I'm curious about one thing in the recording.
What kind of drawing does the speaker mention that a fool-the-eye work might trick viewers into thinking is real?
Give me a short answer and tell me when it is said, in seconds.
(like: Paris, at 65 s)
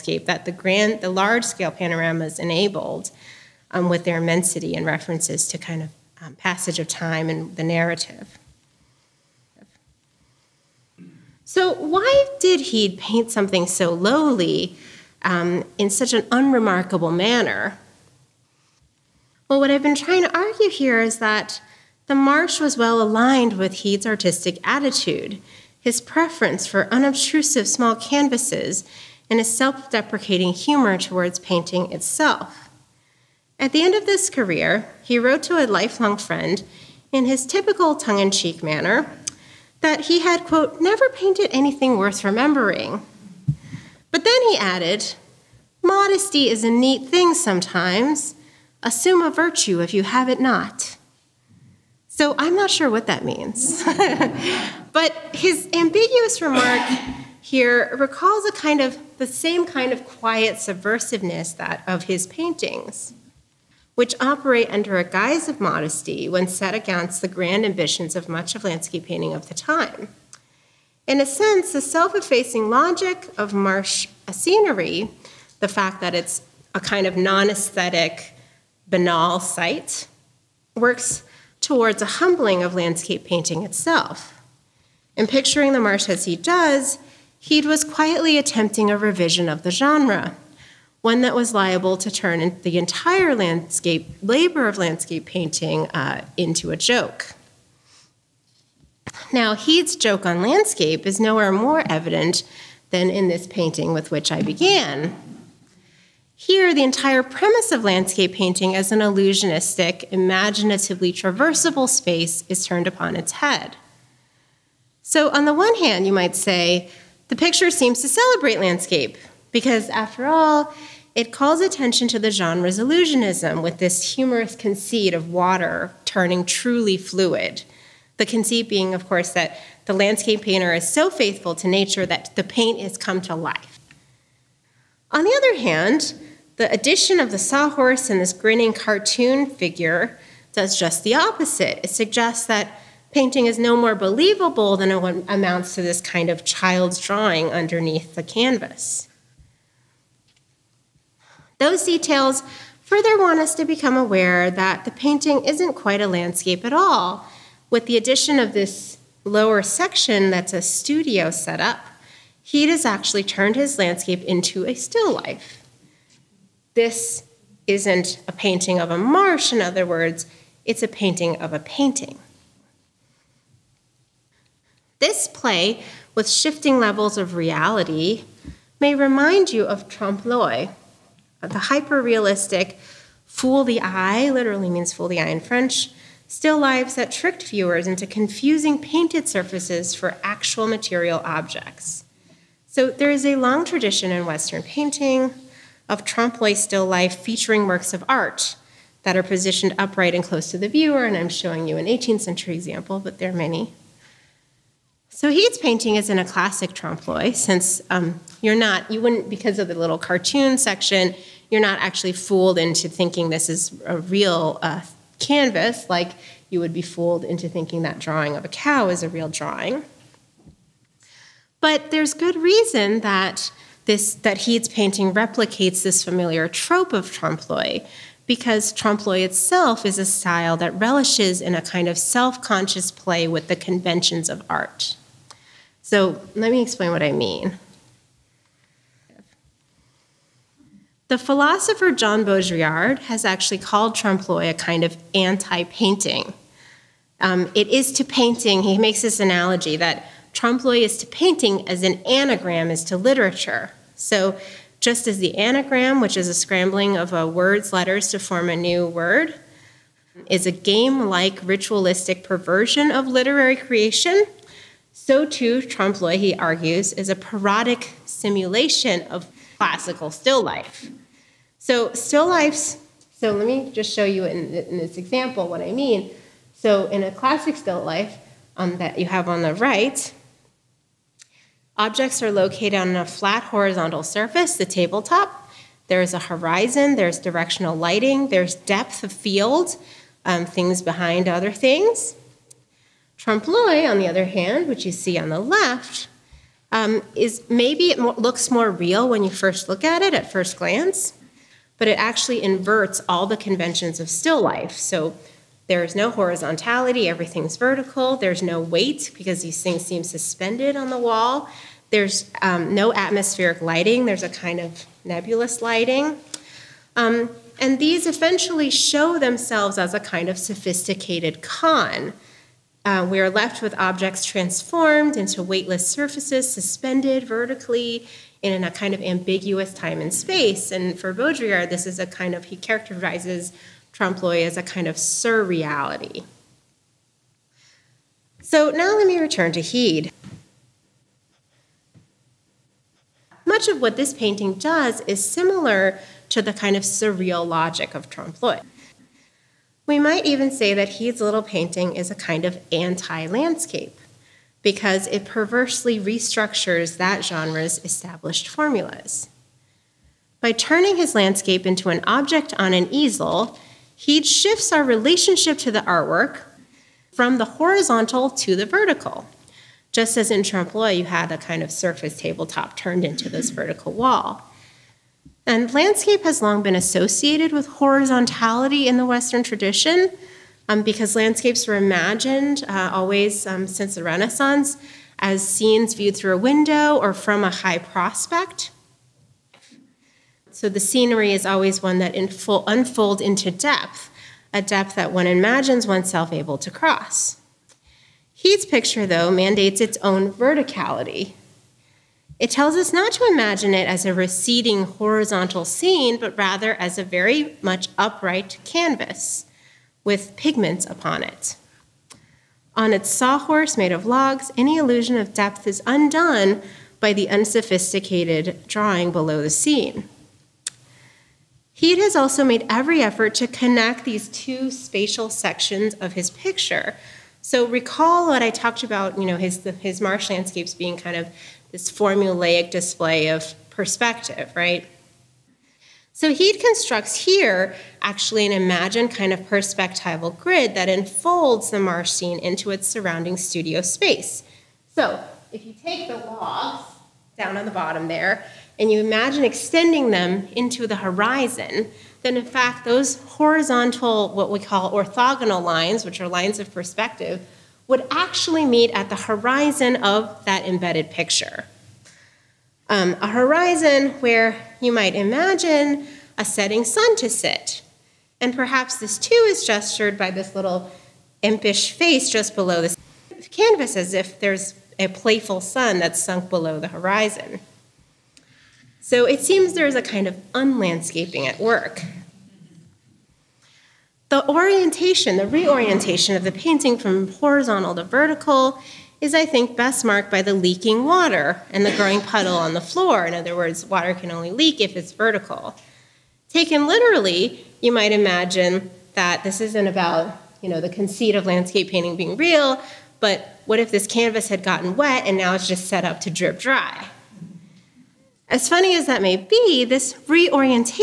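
drawing of a cow, at 217 s.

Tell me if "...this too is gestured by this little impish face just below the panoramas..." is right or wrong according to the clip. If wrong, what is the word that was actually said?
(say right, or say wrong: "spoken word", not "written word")
wrong: "canvas", not "panoramas".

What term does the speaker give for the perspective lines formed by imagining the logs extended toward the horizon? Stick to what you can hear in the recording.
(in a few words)
orthogonal lines.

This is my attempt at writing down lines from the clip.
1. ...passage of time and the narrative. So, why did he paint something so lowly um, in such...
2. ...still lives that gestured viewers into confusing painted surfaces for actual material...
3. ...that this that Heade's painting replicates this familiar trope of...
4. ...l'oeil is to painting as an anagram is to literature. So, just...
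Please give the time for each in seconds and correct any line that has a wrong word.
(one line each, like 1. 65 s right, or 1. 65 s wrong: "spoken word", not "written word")
1. 6 s right
2. 186 s wrong: "tricked", not "gestured"
3. 222 s right
4. 250 s right.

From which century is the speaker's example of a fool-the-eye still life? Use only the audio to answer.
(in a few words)
18th century.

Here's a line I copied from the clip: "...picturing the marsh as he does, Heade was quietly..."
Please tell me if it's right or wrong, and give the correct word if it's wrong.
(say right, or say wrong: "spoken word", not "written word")
right.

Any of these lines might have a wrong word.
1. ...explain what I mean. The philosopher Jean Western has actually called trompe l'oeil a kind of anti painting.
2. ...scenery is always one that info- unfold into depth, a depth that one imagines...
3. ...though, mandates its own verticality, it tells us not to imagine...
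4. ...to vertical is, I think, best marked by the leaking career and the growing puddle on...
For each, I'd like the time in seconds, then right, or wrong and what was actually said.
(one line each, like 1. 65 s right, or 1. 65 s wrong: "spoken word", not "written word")
1. 236 s wrong: "Baudrillard", not "Western"
2. 390 s right
3. 399 s right
4. 487 s wrong: "water", not "career".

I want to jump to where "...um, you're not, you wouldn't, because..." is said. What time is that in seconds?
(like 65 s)
207 s.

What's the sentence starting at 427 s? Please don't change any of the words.
So recall what I talked about, you know, his, his marsh landscapes being kind of this formulaic display of perspective, right?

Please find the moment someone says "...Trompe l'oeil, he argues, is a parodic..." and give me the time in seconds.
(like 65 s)
265 s.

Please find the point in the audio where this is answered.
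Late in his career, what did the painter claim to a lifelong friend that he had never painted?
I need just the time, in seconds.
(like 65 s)
41 s.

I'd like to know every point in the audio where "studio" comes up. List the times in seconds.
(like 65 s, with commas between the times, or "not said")
160 s, 443 s.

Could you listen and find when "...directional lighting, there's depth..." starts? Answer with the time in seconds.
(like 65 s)
287 s.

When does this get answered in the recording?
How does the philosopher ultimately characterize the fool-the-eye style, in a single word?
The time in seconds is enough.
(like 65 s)
334 s.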